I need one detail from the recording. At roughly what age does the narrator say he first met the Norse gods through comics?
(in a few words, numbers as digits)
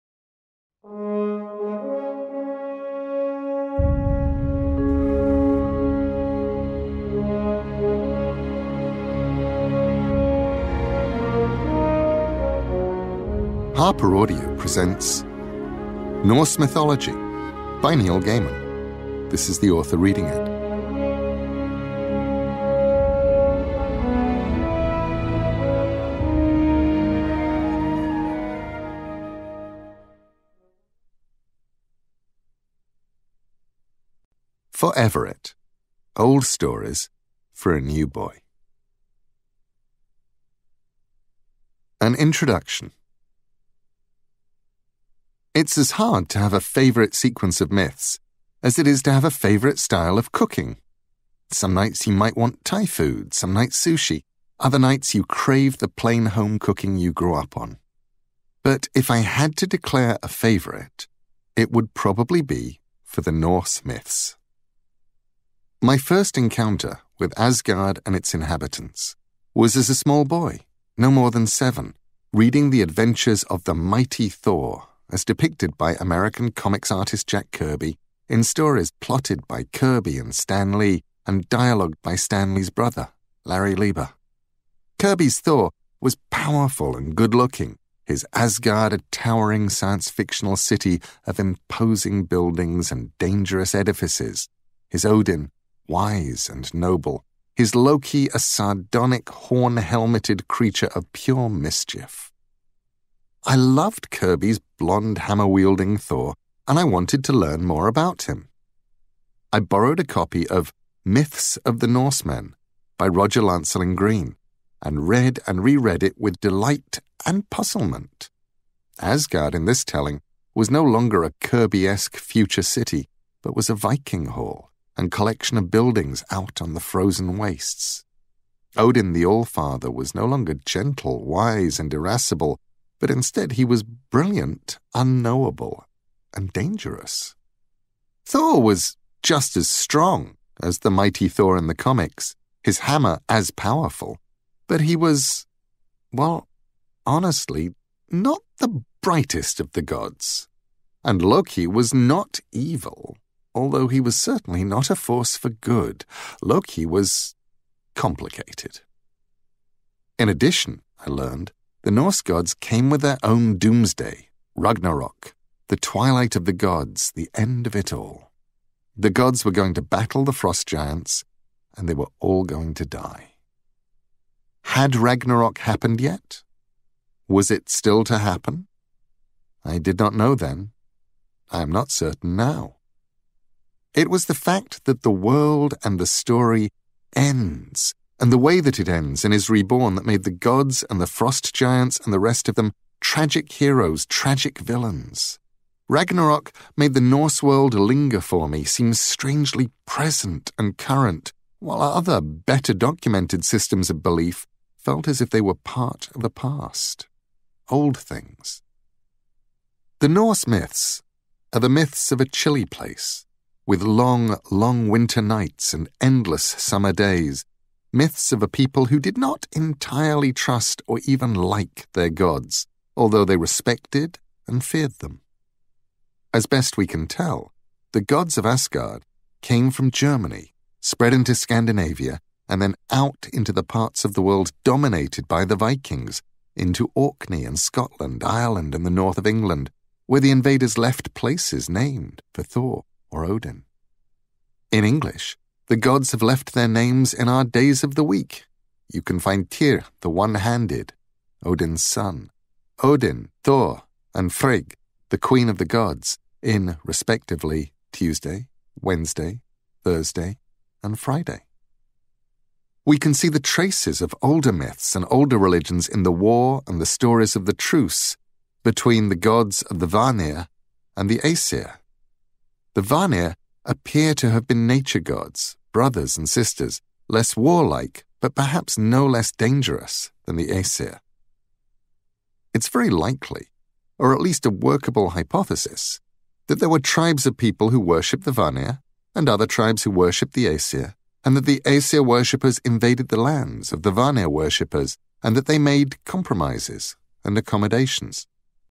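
7.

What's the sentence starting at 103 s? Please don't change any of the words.
I loved Kirby's blonde hammer wielding Thor, and I wanted to learn more about him.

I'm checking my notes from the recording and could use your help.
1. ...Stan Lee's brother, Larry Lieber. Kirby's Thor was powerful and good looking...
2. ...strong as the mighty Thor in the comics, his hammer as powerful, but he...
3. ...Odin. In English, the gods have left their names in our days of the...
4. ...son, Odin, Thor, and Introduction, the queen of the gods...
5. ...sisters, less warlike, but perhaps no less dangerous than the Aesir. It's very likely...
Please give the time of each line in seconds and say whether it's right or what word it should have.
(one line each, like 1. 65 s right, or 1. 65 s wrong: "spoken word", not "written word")
1. 82 s right
2. 139 s right
3. 243 s right
4. 251 s wrong: "Frigg", not "Introduction"
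5. 276 s right.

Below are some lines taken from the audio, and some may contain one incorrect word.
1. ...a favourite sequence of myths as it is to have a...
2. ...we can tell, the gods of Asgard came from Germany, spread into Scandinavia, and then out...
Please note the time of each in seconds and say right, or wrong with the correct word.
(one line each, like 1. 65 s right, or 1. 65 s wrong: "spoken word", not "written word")
1. 46 s right
2. 226 s right.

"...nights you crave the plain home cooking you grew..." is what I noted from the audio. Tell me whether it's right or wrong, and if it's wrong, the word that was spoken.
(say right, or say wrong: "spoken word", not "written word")
right.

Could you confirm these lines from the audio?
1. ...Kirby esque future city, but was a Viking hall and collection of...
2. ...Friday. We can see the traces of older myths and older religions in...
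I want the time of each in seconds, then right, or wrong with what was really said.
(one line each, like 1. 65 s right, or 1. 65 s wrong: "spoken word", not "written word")
1. 121 s right
2. 260 s right.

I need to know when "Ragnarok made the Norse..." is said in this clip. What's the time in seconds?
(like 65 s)
195 s.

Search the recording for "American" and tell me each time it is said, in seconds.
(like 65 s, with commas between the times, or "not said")
75 s.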